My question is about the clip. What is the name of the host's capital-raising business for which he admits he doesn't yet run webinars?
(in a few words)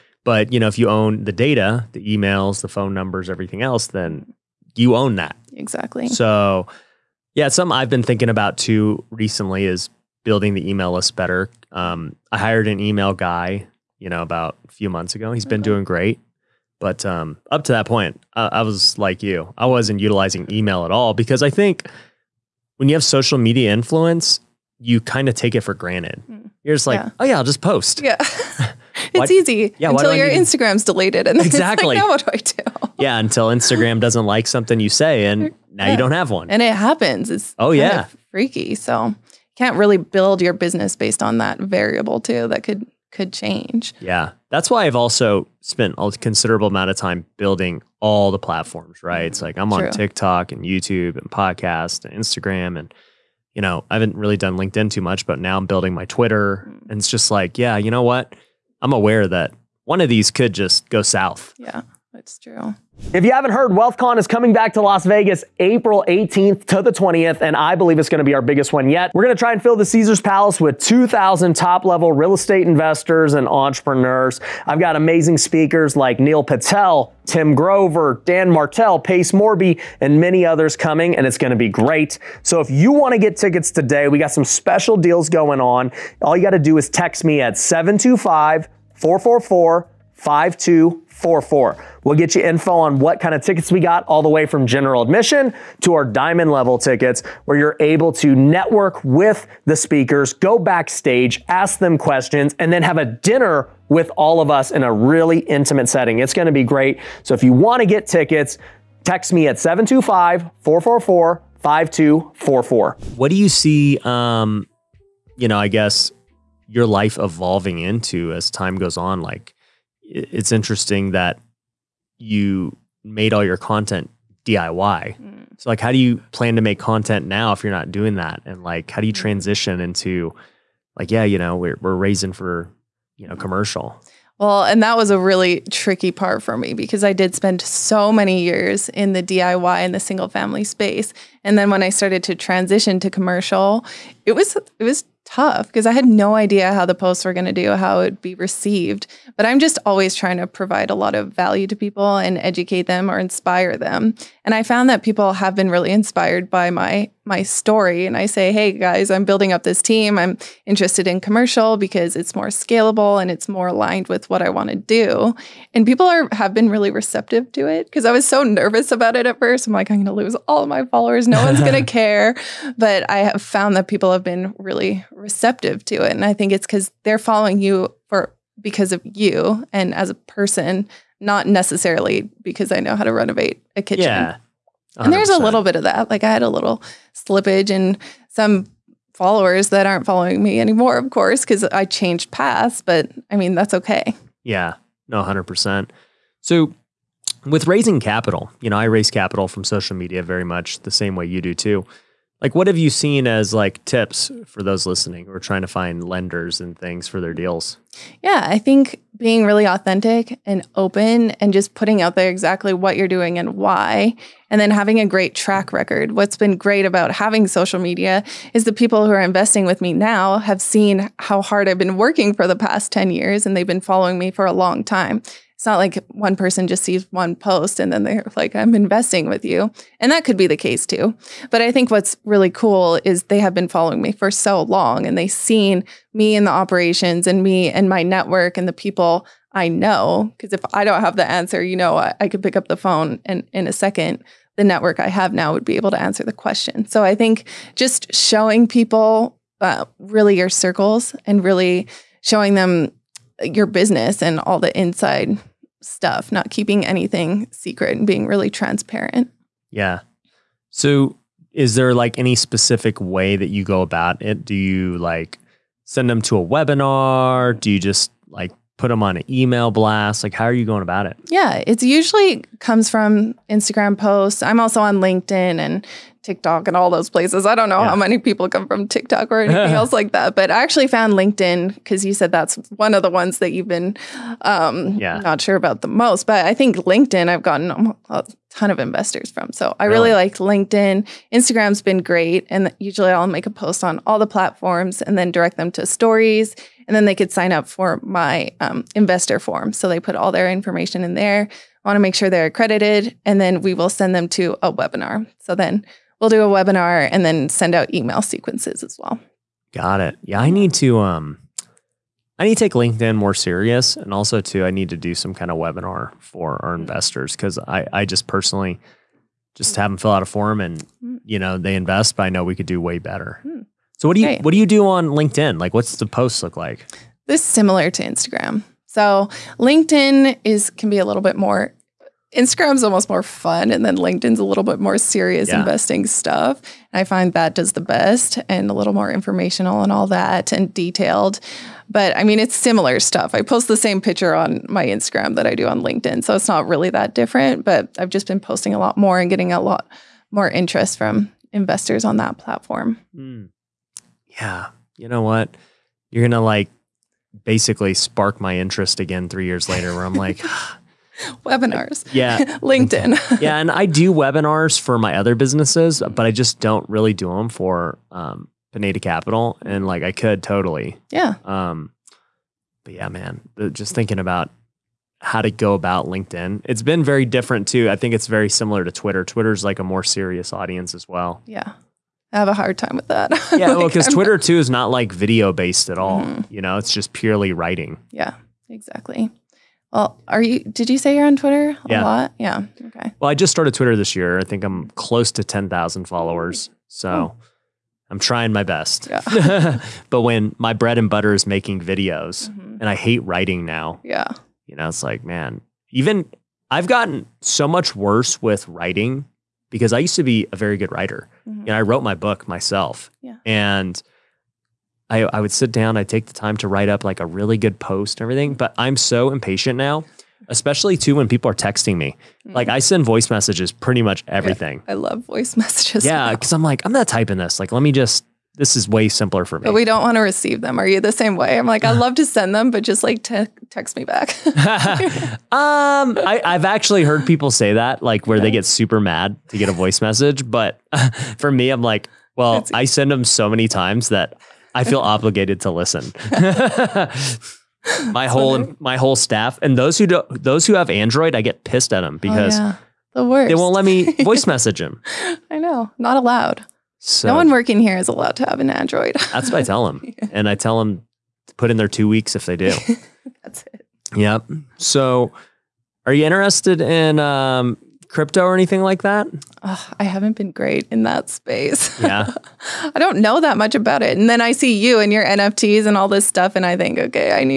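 Pineda Capital.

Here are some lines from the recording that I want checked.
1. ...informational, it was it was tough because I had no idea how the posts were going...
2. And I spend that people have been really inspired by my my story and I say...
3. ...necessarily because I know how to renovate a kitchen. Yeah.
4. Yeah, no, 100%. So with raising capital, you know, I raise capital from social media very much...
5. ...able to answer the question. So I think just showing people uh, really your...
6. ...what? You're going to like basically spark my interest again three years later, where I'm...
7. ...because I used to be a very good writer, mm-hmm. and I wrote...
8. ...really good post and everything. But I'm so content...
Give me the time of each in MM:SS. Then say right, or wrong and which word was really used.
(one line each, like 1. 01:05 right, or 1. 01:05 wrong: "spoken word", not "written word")
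1. 02:23 wrong: "commercial", not "informational"
2. 02:34 wrong: "found", not "spend"
3. 03:01 right
4. 03:14 right
5. 04:05 right
6. 05:55 right
7. 06:49 right
8. 06:57 wrong: "impatient", not "content".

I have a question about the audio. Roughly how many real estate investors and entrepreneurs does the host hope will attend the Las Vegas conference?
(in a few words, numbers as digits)
2,000.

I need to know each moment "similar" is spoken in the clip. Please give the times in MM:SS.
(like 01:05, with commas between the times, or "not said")
05:27, 05:42, 06:18.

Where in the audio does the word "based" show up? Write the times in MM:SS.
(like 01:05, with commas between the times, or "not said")
00:40, 06:25.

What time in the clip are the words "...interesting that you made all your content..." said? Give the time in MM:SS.
02:00.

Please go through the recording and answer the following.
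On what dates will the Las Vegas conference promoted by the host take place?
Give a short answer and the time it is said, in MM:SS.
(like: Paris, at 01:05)
April 18th to the 20th, at 01:05.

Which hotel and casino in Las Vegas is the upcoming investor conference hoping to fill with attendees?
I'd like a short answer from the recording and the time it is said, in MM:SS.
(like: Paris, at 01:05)
Caesars Palace, at 01:09.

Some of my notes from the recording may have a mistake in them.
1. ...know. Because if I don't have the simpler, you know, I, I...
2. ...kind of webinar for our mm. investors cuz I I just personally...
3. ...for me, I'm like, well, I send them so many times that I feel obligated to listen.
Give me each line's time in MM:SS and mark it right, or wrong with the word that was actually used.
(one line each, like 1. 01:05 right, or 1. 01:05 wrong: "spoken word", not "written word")
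1. 03:59 wrong: "answer", not "simpler"
2. 05:15 right
3. 07:21 right.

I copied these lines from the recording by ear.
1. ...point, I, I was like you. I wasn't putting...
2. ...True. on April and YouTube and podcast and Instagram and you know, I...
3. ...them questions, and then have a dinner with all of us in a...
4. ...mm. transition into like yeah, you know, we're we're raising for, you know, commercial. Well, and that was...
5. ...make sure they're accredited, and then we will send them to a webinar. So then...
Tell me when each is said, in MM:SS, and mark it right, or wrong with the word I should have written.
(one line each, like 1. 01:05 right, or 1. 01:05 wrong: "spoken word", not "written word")
1. 00:17 wrong: "utilizing", not "putting"
2. 00:49 wrong: "TikTok", not "April"
3. 01:41 right
4. 02:09 right
5. 05:01 right.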